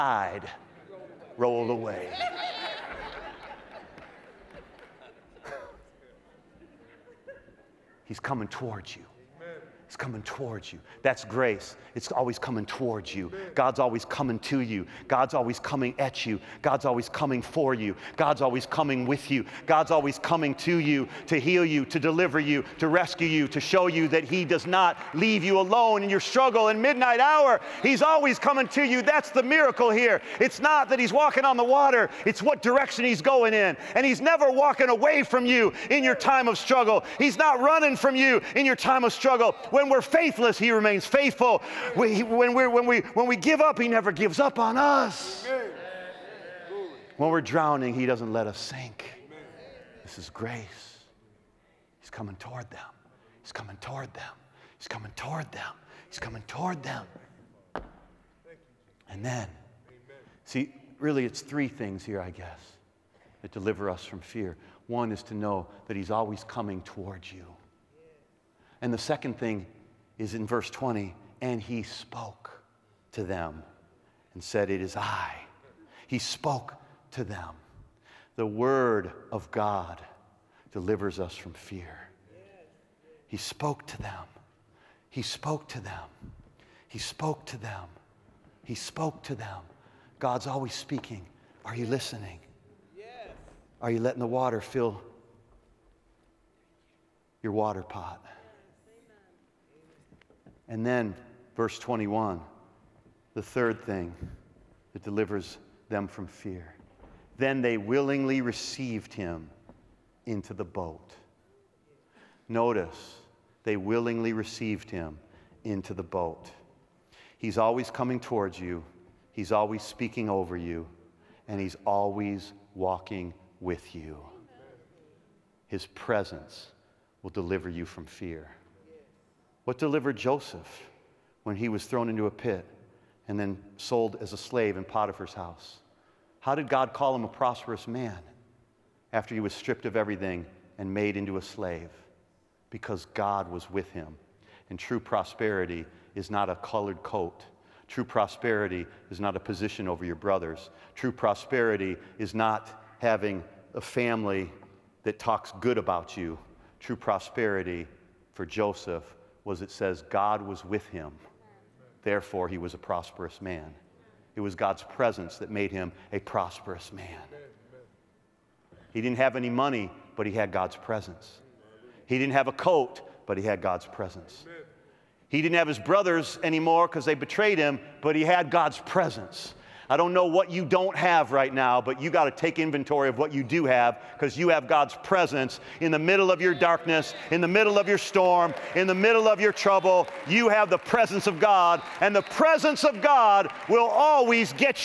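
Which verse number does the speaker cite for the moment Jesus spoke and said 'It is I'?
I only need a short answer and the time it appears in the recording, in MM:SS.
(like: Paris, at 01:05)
20, at 01:10.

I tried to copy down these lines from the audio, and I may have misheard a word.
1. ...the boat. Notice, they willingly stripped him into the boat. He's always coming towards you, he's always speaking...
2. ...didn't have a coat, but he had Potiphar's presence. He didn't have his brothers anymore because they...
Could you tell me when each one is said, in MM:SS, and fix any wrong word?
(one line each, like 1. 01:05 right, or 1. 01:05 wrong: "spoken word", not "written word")
1. 01:50 wrong: "received", not "stripped"
2. 02:52 wrong: "God", not "Potiphar".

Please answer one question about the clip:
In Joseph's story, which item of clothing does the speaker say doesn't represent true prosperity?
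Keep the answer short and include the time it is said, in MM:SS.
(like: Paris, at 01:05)
A colored coat, at 02:26.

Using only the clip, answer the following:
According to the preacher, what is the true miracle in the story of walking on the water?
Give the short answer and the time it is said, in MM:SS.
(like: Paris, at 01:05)
What direction He's going in, at 00:32.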